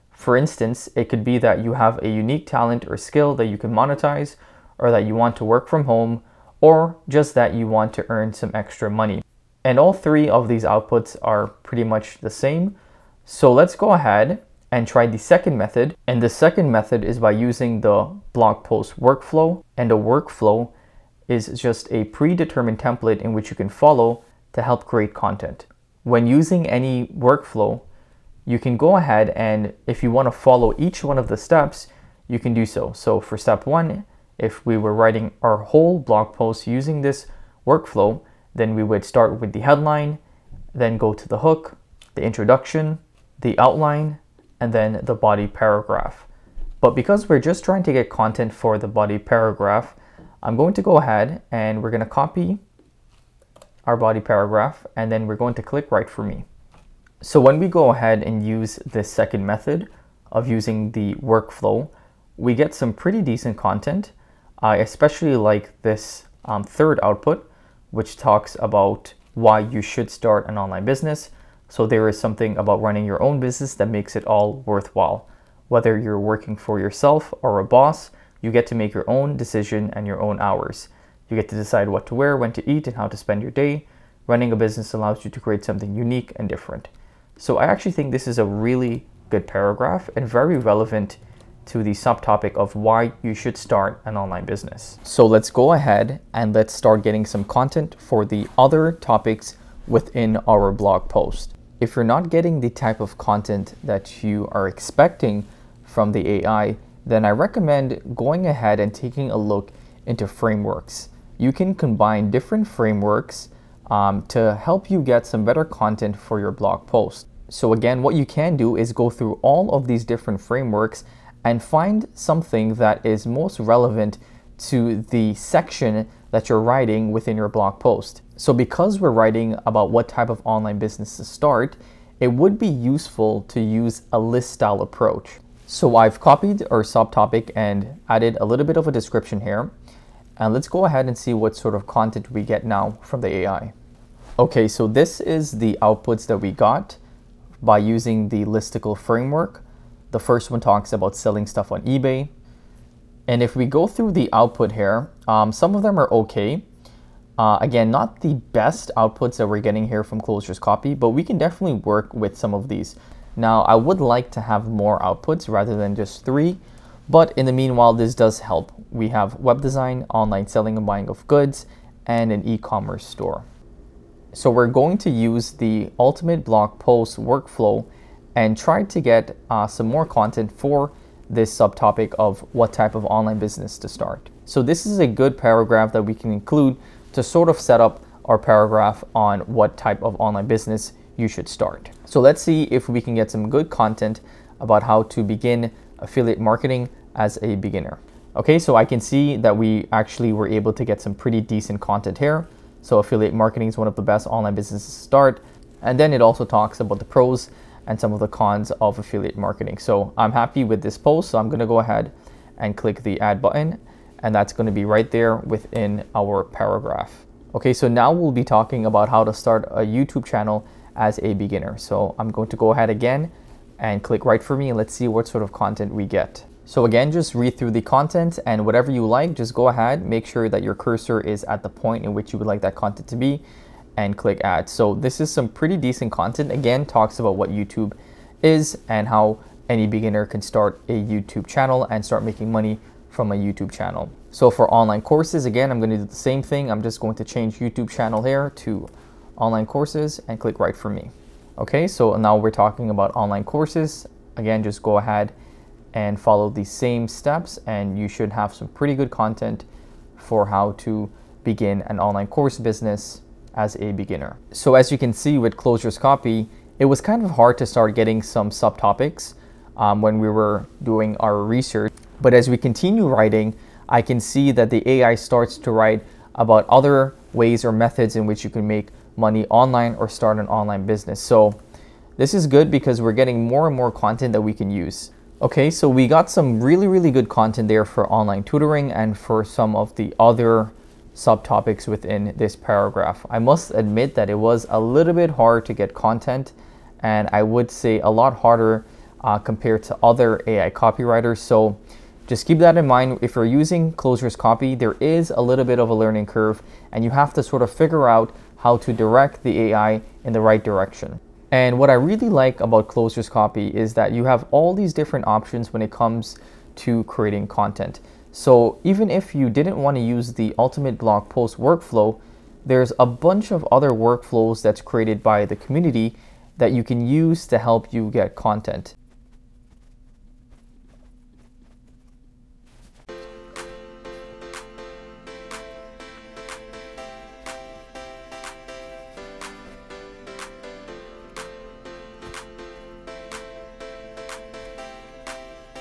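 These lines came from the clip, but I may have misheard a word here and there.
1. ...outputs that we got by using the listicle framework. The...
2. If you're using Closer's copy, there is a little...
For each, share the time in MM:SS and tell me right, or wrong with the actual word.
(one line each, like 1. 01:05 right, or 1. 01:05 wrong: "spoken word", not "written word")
1. 02:25 right
2. 05:03 right.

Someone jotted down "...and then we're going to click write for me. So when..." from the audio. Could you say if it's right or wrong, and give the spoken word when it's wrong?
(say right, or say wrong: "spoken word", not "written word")
right.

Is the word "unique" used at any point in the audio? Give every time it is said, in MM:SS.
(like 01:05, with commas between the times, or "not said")
00:02, 01:25.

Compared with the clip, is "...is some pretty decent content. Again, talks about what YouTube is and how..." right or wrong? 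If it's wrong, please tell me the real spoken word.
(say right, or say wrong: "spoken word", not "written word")
right.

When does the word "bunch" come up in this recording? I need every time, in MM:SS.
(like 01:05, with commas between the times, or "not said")
05:23.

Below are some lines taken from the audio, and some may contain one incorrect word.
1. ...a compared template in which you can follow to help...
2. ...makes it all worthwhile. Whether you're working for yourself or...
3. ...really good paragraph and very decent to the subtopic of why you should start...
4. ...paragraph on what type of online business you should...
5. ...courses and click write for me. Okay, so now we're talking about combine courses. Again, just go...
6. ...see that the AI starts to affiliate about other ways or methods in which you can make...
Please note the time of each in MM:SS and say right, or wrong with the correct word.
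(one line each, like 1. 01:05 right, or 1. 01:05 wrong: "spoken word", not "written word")
1. 00:21 wrong: "predetermined", not "compared"
2. 01:13 right
3. 01:28 wrong: "relevant", not "decent"
4. 03:08 right
5. 04:09 wrong: "online", not "combine"
6. 04:34 wrong: "write", not "affiliate".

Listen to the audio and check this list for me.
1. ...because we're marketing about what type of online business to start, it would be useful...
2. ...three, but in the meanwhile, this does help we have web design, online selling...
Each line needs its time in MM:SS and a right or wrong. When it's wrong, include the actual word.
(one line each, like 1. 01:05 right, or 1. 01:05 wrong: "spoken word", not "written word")
1. 02:08 wrong: "writing", not "marketing"
2. 02:46 right.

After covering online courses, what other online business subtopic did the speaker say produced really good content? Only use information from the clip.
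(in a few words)
Online tutoring.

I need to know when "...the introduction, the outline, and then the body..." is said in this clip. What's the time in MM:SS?
00:42.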